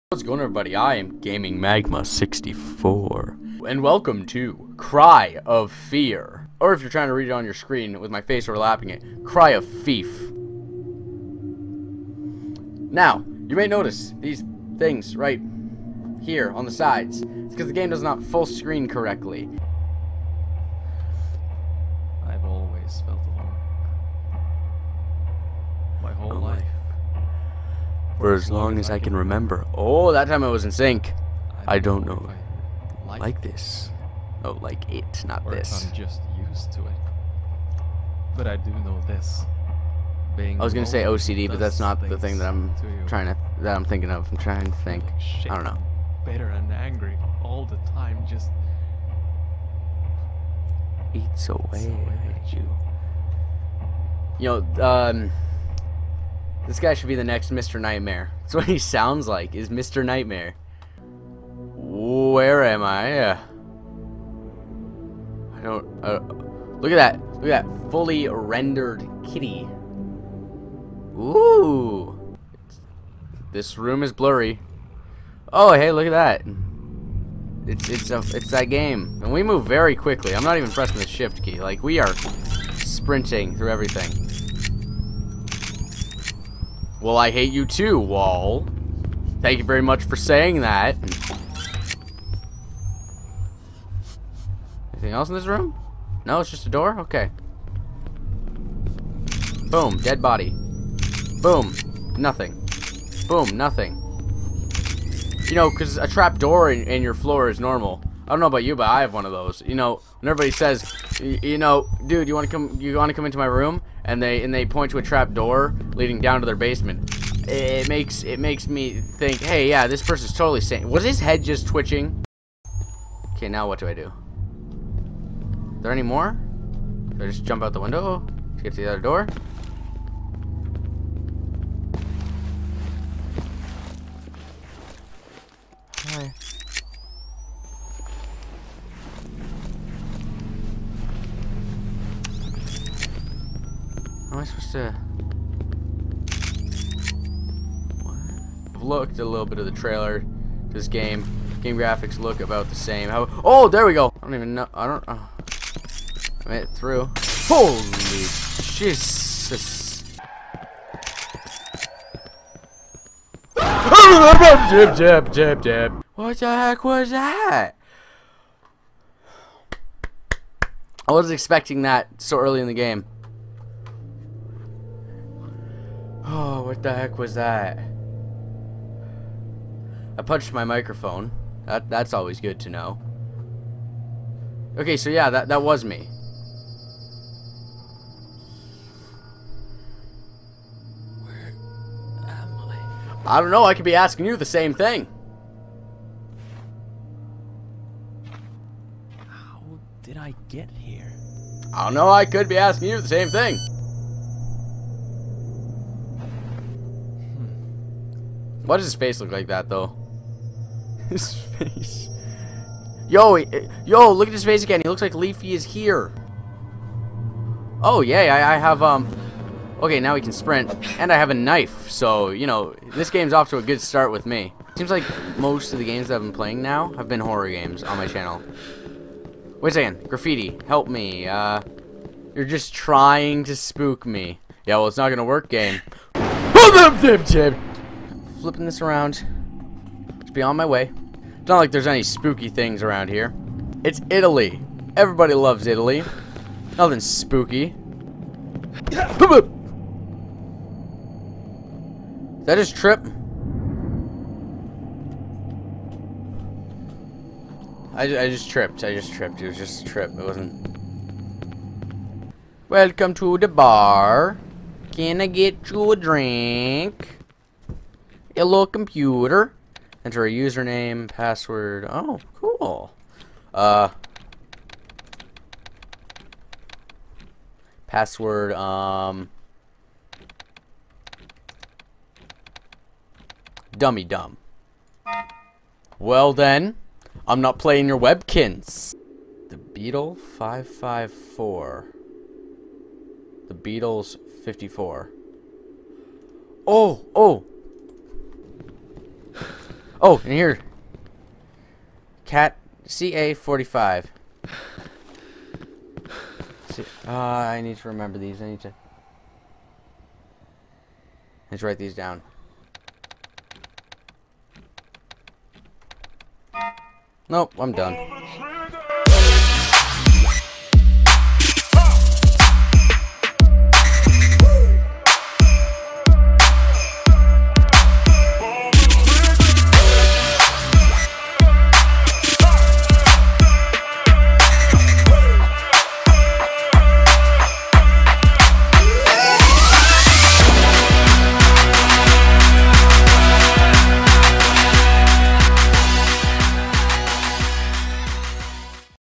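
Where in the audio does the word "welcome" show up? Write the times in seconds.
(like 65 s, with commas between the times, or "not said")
3 s, 262 s.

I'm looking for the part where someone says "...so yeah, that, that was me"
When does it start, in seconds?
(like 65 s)
184 s.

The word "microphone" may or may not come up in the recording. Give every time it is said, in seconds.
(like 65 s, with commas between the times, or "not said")
180 s.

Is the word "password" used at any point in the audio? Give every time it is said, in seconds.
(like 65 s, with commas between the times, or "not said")
271 s, 277 s.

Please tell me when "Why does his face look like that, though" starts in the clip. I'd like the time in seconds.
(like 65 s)
208 s.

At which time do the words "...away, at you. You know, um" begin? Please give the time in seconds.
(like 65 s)
51 s.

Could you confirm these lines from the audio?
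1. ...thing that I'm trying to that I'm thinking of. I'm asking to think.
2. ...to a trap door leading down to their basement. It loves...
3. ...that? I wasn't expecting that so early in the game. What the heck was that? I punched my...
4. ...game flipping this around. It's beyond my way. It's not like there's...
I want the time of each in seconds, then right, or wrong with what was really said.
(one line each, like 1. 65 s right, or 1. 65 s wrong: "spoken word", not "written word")
1. 42 s wrong: "trying", not "asking"
2. 114 s wrong: "makes", not "loves"
3. 167 s right
4. 235 s right.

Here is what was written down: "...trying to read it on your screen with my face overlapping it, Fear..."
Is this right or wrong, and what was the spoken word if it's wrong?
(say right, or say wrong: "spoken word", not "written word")
wrong: "Cry", not "Fear".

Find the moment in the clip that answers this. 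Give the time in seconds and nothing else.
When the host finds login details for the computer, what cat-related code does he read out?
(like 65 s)
302 s.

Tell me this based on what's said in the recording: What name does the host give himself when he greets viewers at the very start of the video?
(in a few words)
Gaming Magma 64.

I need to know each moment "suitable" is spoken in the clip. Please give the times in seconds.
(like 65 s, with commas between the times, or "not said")
not said.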